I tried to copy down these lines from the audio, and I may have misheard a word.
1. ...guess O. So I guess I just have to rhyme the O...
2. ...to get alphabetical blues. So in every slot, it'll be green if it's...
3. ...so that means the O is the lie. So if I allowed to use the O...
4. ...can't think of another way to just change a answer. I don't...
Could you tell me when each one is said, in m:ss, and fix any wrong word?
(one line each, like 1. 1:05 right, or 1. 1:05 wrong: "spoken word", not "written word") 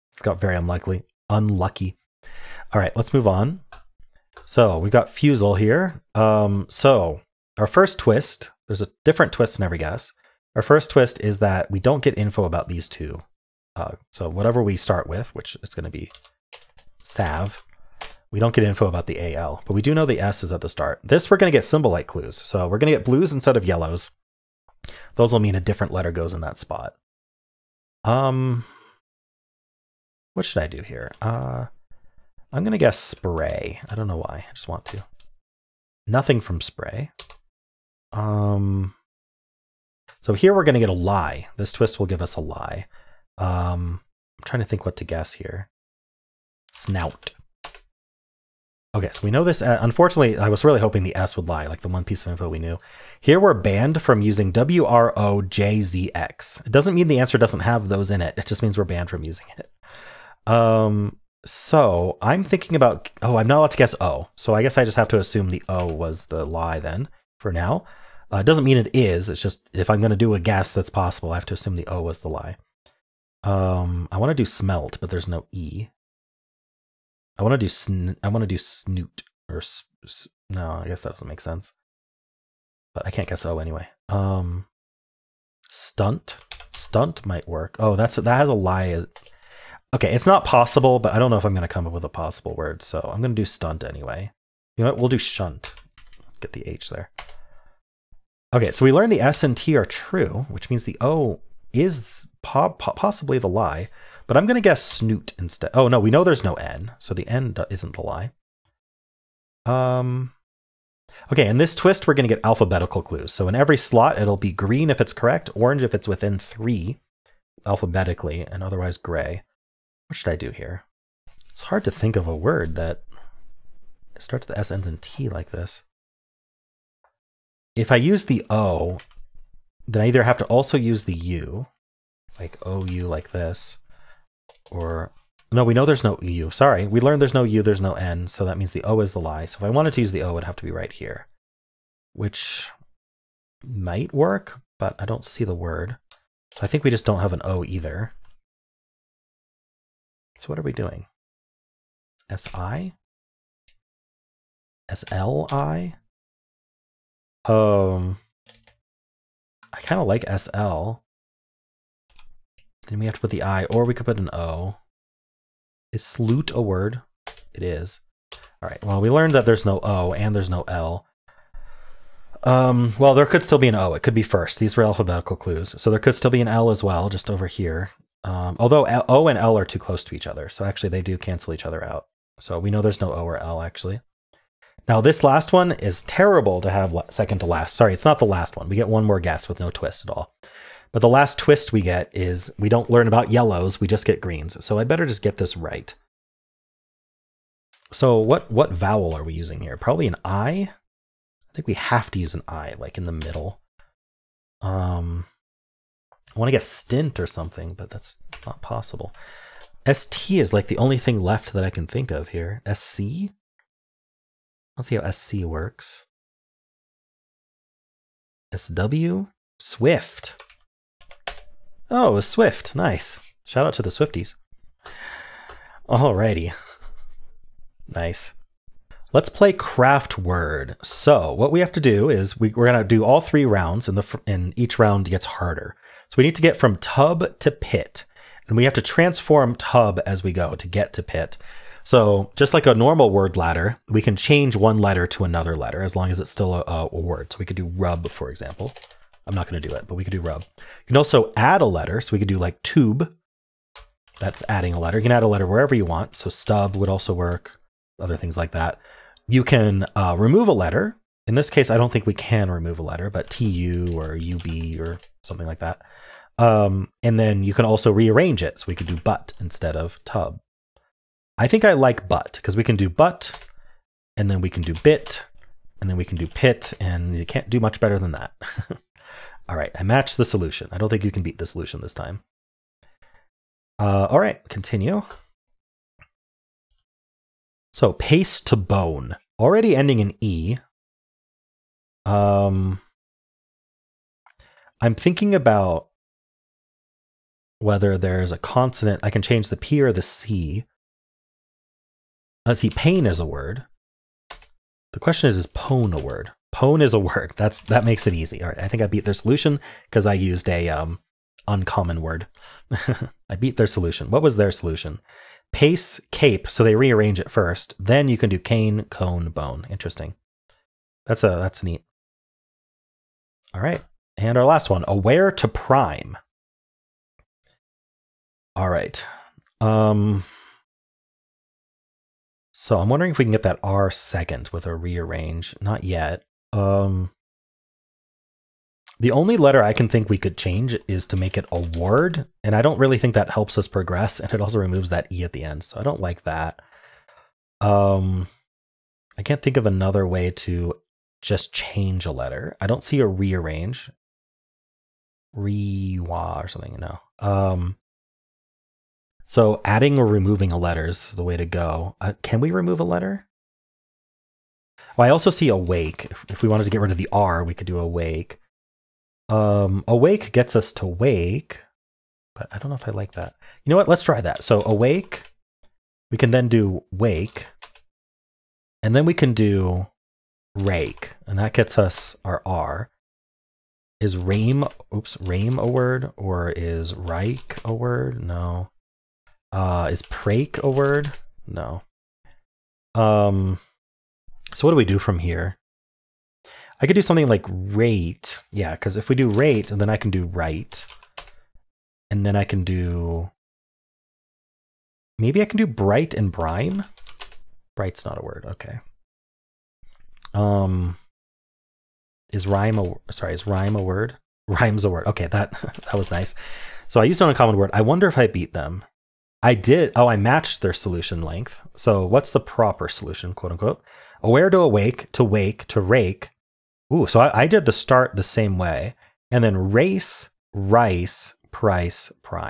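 1. 1:03 wrong: "assume", not "rhyme"
2. 1:52 wrong: "clues", not "blues"
3. 2:18 wrong: "wanted", not "allowed"
4. 5:49 wrong: "letter", not "answer".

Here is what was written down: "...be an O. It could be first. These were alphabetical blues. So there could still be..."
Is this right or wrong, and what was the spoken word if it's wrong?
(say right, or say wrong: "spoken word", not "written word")
wrong: "clues", not "blues".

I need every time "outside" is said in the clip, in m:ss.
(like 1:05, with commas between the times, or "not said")
not said.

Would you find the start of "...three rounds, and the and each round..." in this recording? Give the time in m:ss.
3:53.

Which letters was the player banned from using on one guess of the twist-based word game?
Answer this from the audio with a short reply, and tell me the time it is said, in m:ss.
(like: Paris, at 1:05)
WROJZX, at 0:54.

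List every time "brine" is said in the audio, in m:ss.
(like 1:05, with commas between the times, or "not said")
6:46.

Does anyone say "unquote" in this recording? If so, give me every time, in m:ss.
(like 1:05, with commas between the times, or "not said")
7:03.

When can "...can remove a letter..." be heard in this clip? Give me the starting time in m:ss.
4:22.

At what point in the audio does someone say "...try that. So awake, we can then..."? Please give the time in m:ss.
6:14.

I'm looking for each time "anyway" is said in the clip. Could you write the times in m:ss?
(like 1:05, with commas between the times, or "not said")
1:23, 1:33.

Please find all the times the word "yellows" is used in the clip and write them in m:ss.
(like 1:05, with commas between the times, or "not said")
0:23, 3:13.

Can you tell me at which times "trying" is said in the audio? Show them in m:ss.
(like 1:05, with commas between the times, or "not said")
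0:44.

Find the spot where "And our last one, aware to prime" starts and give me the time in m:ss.
5:24.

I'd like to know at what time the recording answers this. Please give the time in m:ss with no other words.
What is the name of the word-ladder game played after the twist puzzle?
3:49.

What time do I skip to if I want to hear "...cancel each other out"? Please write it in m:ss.
3:01.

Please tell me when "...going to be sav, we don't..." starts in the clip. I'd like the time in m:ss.
0:15.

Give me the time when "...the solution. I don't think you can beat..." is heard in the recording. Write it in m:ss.
4:40.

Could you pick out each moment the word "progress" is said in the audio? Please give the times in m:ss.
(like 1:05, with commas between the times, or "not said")
5:43.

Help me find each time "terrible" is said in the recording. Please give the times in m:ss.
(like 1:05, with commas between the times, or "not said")
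3:06.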